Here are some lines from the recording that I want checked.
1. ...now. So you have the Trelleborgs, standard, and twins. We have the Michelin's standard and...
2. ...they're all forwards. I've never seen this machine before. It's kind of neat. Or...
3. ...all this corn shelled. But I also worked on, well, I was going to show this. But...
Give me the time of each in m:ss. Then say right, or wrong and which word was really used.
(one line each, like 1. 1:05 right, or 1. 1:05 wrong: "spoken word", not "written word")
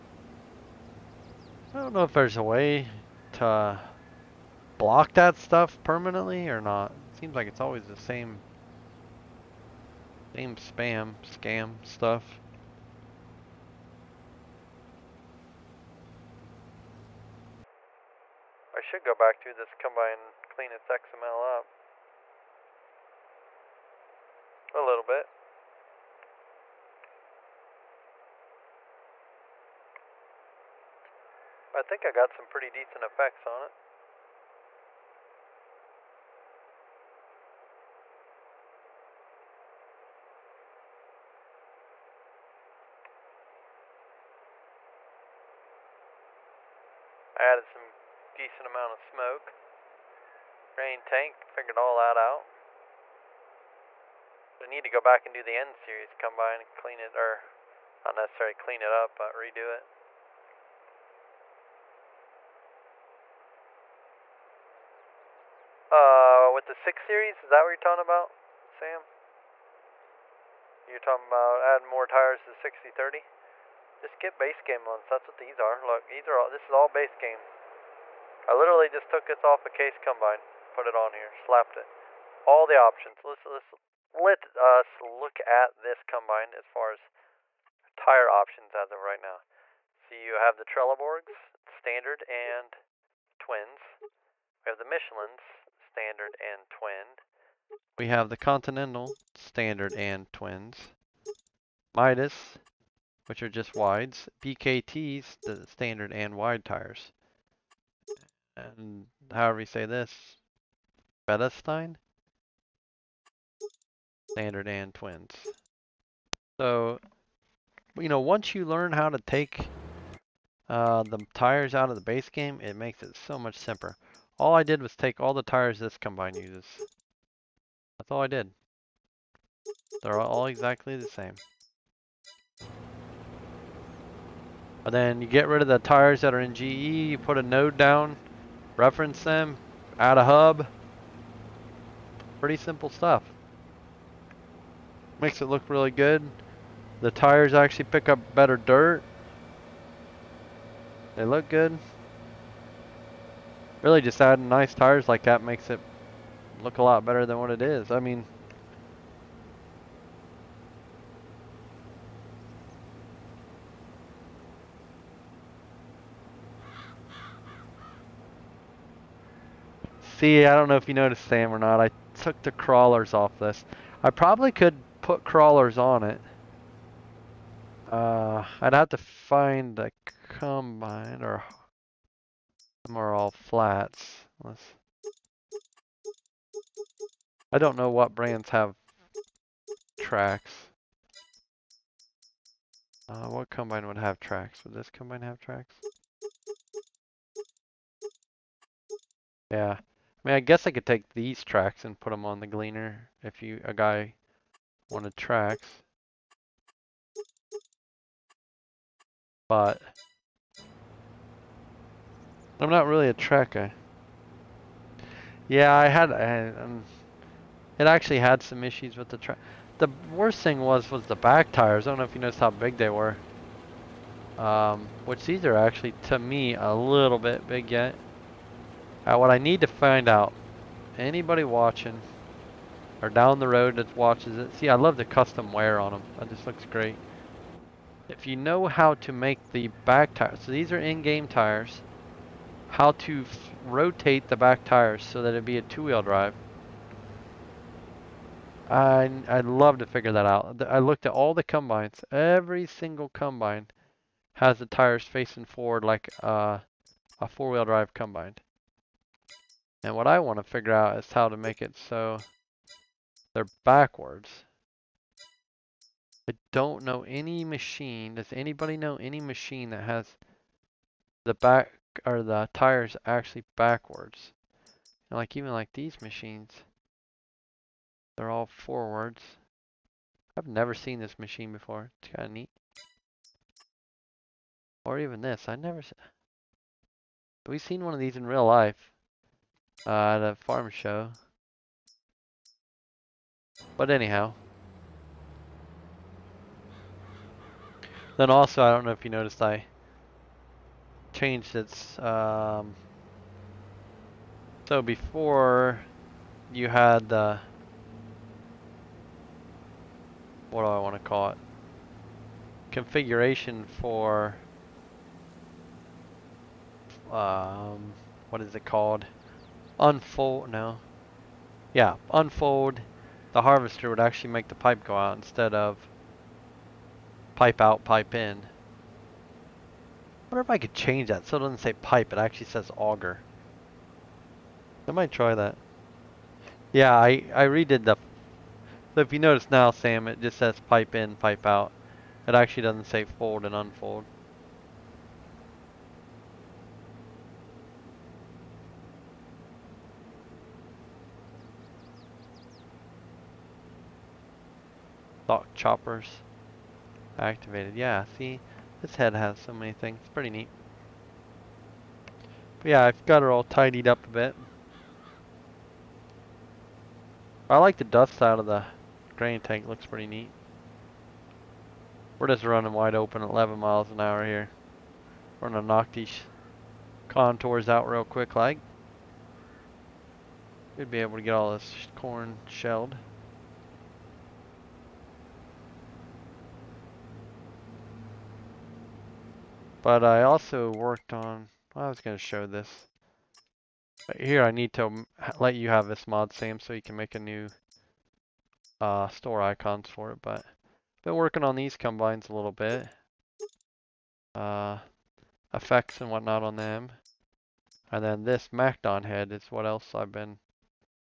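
1. 1:29 right
2. 4:38 right
3. 6:21 right.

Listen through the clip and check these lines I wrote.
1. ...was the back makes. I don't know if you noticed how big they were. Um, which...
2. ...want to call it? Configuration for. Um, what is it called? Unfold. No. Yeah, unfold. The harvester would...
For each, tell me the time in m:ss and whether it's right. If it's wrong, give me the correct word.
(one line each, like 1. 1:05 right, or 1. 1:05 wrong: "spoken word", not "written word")
1. 3:40 wrong: "tires", not "makes"
2. 5:10 right.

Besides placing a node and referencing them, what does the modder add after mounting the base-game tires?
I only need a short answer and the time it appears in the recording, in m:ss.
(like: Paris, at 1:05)
A hub, at 2:19.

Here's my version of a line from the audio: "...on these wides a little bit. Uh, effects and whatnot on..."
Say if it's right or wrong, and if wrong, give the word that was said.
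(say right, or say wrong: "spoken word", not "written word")
wrong: "combines", not "wides".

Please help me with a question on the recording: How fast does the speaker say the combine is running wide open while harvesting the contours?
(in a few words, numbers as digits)
11 miles an hour.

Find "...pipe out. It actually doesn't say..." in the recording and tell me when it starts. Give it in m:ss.
5:41.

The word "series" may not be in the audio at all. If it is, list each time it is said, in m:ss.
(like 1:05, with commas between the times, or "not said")
0:55, 1:07.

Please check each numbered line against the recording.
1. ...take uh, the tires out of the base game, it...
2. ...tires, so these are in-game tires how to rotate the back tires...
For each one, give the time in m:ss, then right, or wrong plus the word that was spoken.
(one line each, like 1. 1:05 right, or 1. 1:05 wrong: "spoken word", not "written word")
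1. 1:59 right
2. 4:00 right.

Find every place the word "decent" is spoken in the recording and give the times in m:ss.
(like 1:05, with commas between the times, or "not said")
0:32, 0:48.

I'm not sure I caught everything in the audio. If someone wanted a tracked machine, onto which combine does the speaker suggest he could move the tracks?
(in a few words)
The Gleaner.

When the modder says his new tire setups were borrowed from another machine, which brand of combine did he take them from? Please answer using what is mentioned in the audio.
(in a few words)
Case.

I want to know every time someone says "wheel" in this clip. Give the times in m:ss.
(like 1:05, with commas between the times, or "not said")
4:05, 4:17.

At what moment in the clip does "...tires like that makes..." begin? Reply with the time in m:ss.
2:34.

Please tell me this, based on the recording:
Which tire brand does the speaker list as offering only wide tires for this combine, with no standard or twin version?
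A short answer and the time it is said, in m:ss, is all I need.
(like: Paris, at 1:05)
Midas, at 1:41.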